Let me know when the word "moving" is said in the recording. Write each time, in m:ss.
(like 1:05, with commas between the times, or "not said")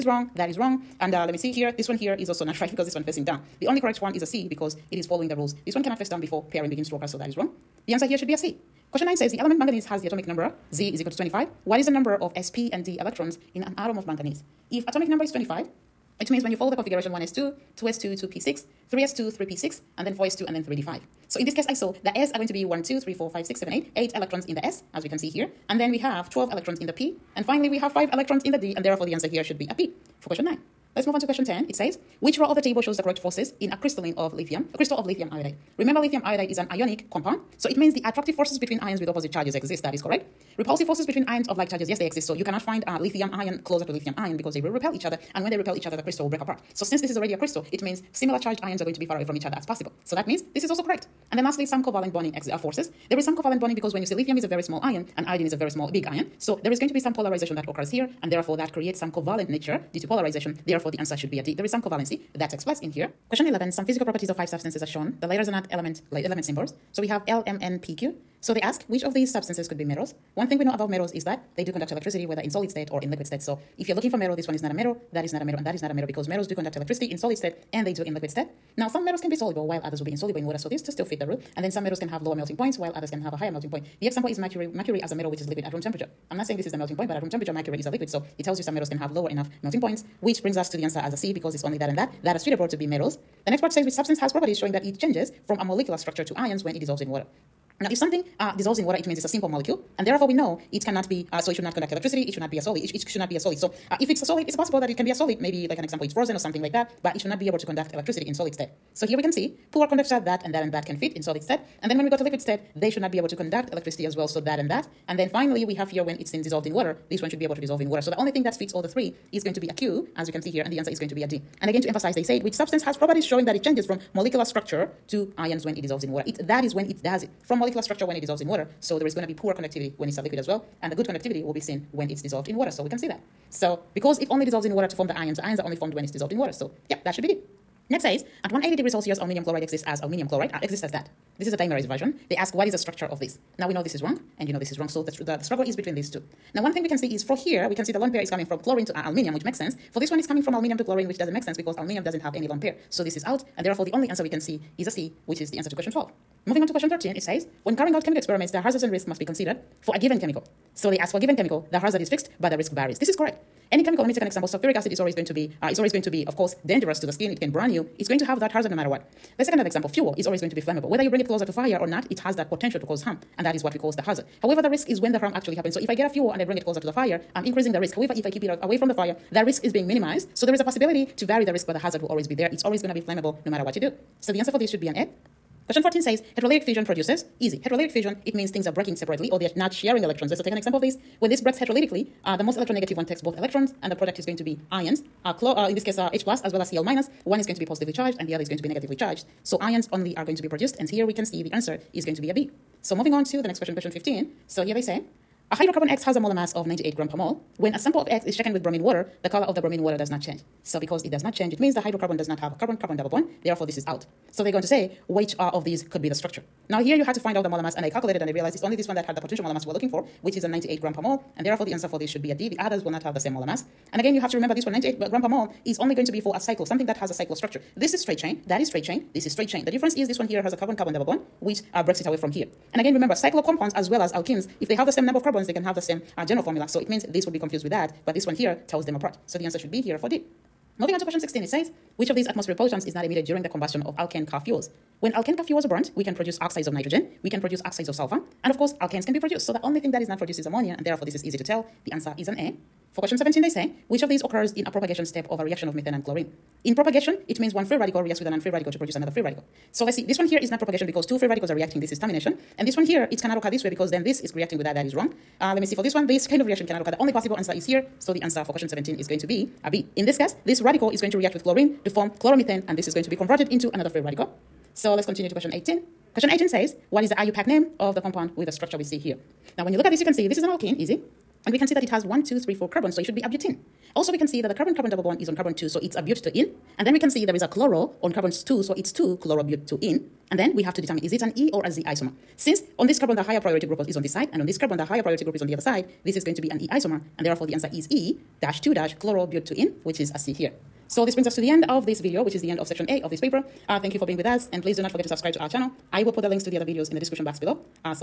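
2:36, 3:22, 4:00.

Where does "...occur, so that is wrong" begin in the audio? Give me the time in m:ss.
0:06.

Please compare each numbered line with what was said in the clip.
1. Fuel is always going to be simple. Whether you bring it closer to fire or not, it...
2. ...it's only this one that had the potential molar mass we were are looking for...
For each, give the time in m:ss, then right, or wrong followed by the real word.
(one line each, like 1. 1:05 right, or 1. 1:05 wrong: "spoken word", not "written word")
1. 2:49 wrong: "flammable", not "simple"
2. 3:38 right.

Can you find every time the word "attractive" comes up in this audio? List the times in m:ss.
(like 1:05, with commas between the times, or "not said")
0:38.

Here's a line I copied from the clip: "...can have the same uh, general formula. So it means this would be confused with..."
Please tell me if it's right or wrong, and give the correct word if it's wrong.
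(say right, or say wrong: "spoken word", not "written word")
right.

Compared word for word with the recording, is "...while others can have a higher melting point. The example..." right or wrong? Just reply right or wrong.
right.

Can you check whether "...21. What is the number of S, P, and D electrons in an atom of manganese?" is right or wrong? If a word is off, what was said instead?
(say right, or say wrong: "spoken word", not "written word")
wrong: "25", not "21".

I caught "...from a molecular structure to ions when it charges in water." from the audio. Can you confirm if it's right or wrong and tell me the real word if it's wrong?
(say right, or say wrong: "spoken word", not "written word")
wrong: "dissolves", not "charges".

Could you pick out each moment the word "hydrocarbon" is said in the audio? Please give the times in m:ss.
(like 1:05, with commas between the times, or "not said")
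3:25, 3:31.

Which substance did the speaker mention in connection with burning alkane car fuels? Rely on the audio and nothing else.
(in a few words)
ammonia.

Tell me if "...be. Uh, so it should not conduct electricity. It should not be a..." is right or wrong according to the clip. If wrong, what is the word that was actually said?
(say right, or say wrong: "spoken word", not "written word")
right.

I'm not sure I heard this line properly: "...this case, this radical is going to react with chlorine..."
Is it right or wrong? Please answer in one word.
right.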